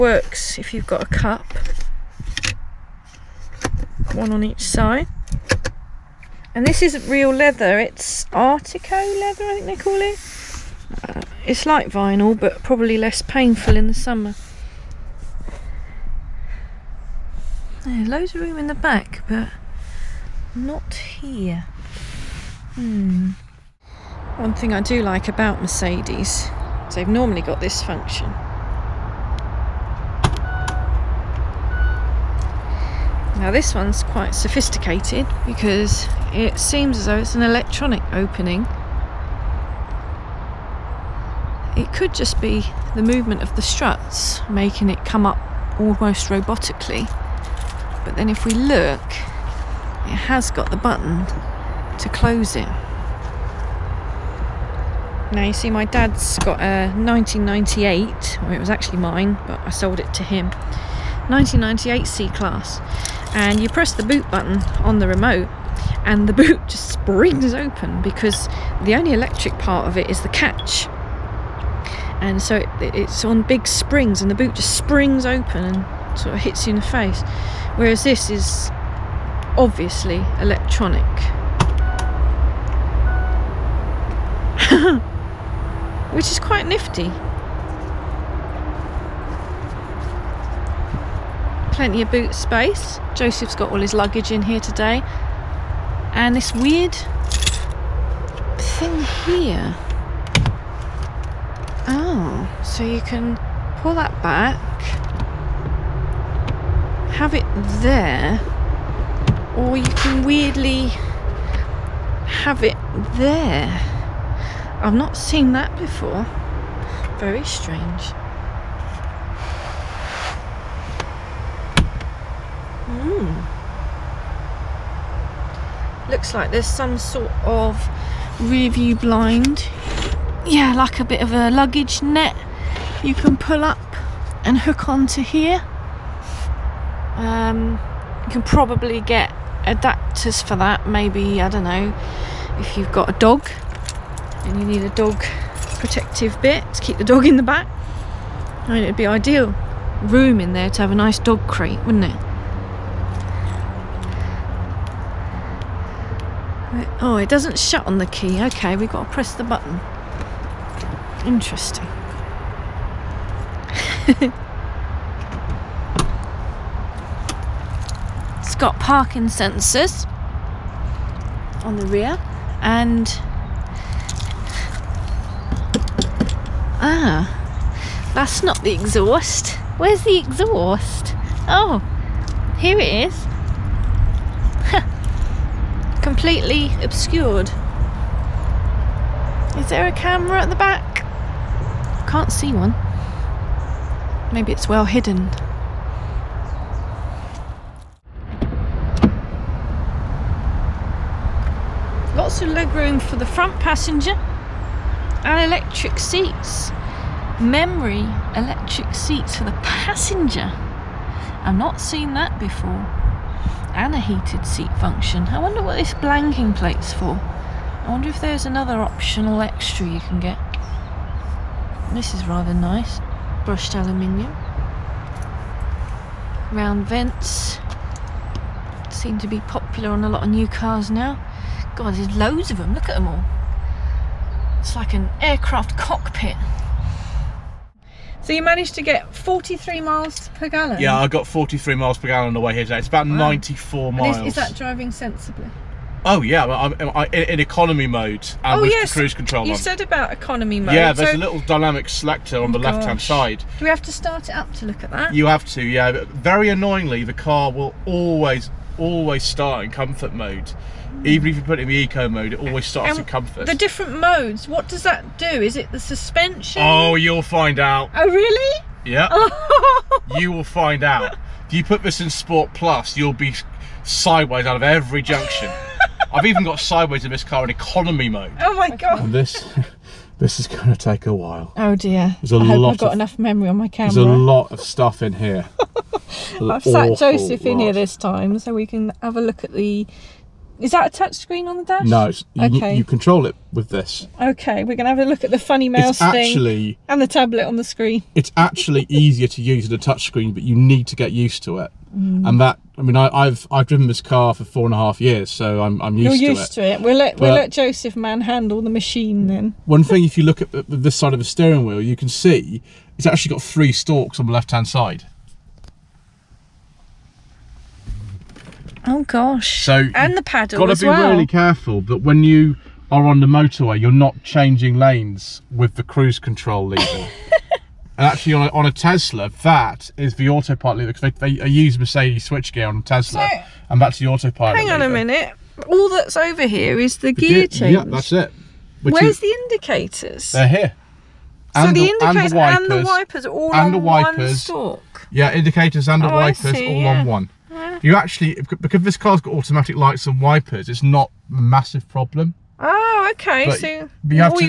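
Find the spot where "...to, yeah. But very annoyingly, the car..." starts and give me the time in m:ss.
4:15.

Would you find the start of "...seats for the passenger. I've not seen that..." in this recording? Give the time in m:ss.
3:28.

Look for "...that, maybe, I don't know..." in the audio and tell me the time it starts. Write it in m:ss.
2:20.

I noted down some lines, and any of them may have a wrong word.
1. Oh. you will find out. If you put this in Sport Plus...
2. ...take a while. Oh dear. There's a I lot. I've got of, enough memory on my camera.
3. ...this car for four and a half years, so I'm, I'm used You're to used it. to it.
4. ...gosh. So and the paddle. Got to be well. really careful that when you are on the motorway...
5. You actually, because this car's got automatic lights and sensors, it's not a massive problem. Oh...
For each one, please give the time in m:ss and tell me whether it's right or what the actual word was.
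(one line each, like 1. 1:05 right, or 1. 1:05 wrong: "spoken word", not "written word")
1. 4:29 right
2. 4:40 right
3. 5:03 right
4. 5:19 right
5. 5:47 wrong: "wipers", not "sensors".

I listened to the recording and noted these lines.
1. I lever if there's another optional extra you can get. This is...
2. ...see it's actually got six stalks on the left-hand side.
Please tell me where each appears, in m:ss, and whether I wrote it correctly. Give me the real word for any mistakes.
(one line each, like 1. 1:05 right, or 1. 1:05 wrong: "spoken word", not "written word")
1. 3:37 wrong: "wonder", not "lever"
2. 5:12 wrong: "three", not "six".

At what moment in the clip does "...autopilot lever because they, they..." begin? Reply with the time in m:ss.
5:30.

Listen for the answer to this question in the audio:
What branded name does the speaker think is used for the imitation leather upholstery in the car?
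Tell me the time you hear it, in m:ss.
0:08.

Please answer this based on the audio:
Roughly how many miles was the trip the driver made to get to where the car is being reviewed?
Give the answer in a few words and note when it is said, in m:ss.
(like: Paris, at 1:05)
94 miles, at 4:03.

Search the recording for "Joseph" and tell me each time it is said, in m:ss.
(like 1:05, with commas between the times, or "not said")
1:33, 4:46, 5:07.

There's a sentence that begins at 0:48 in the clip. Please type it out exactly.
But then if we look, it has got the button to close it.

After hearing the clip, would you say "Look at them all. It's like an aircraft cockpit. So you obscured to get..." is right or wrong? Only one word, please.
wrong.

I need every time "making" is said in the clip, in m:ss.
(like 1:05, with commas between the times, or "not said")
0:44.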